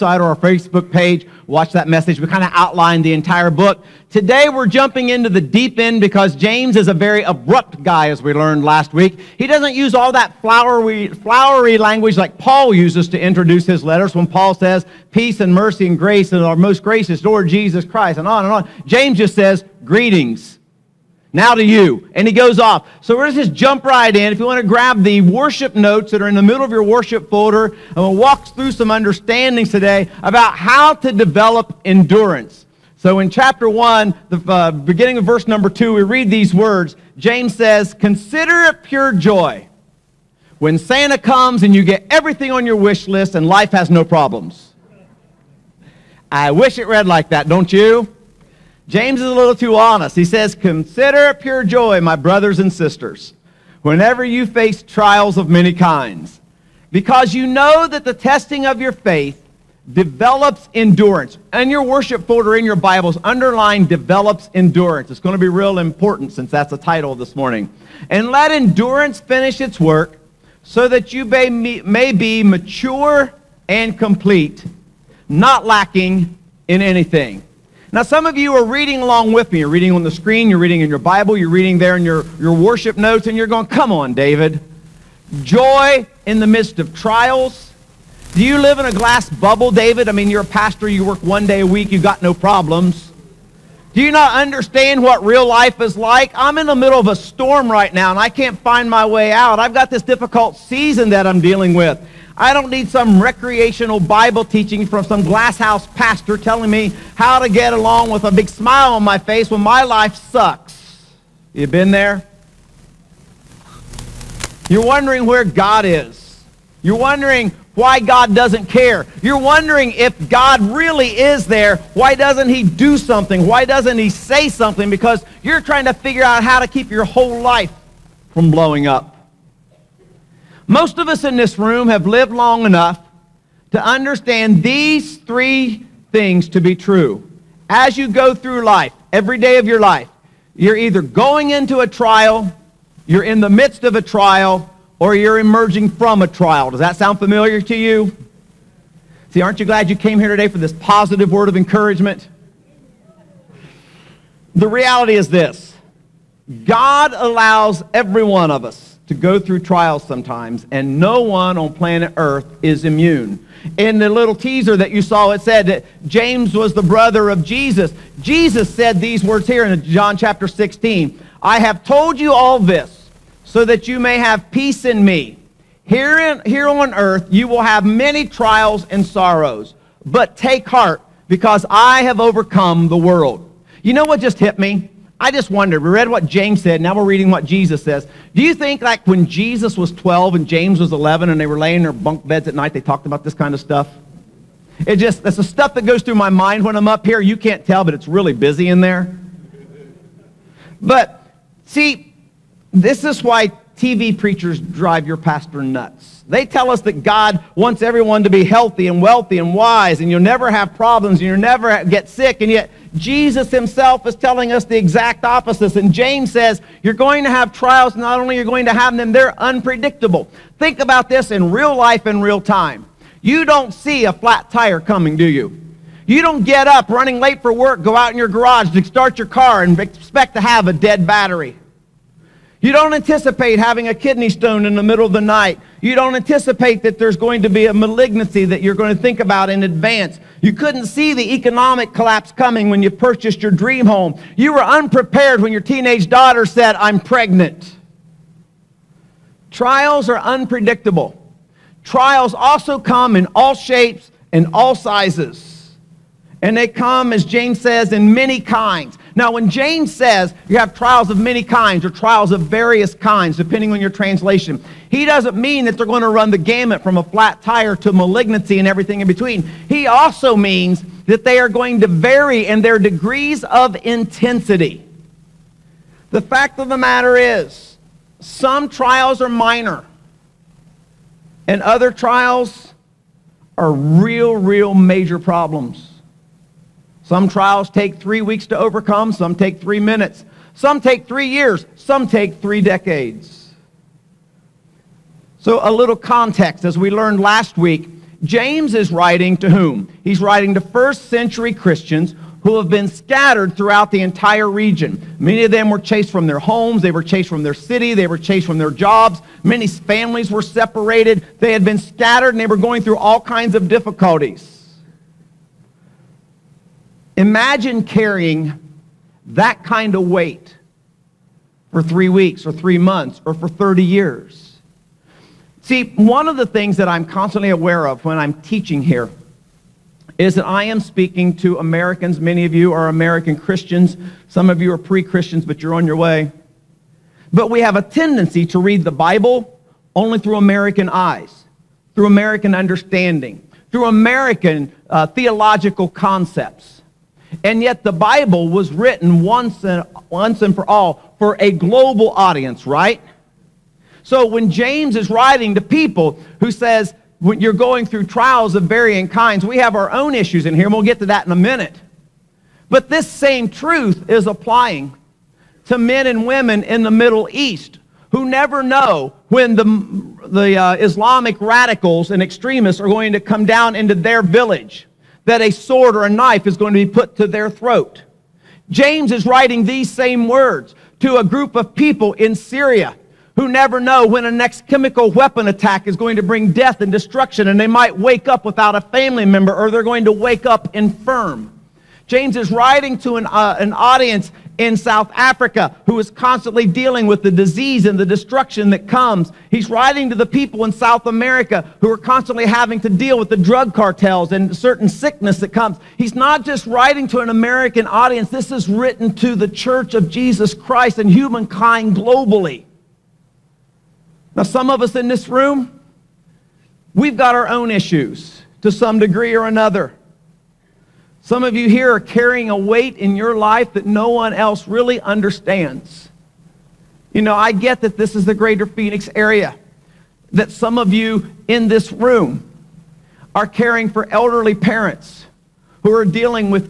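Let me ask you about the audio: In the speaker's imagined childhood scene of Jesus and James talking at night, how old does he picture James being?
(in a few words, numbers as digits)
11.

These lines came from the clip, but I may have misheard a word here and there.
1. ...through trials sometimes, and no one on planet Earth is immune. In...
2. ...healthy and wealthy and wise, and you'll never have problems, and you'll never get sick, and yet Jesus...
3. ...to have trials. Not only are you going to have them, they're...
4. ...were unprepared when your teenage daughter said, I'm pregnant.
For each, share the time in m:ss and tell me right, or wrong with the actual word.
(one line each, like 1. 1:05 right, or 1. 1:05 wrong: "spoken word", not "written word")
1. 2:39 right
2. 3:28 right
3. 3:37 right
4. 4:04 right.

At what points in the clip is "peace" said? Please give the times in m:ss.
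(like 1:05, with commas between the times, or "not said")
0:15, 2:54.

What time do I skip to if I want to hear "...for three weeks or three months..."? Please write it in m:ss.
5:21.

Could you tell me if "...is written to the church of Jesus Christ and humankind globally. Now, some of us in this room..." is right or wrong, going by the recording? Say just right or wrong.
right.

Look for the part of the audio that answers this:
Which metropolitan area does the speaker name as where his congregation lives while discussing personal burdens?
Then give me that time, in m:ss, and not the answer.
7:08.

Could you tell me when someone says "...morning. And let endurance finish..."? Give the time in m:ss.
1:07.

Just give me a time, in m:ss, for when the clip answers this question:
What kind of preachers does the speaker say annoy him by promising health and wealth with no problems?
3:23.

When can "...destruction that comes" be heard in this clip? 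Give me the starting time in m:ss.
6:38.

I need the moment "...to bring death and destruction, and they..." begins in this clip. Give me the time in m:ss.
6:26.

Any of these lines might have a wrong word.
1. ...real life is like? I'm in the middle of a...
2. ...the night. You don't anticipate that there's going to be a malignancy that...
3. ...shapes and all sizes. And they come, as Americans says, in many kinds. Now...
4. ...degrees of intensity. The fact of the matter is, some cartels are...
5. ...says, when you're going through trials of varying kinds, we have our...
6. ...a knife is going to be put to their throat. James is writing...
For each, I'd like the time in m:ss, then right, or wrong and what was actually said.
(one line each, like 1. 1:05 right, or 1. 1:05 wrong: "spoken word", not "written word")
1. 1:35 right
2. 3:55 right
3. 4:13 wrong: "James", not "Americans"
4. 4:32 wrong: "trials", not "cartels"
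5. 5:56 right
6. 6:16 right.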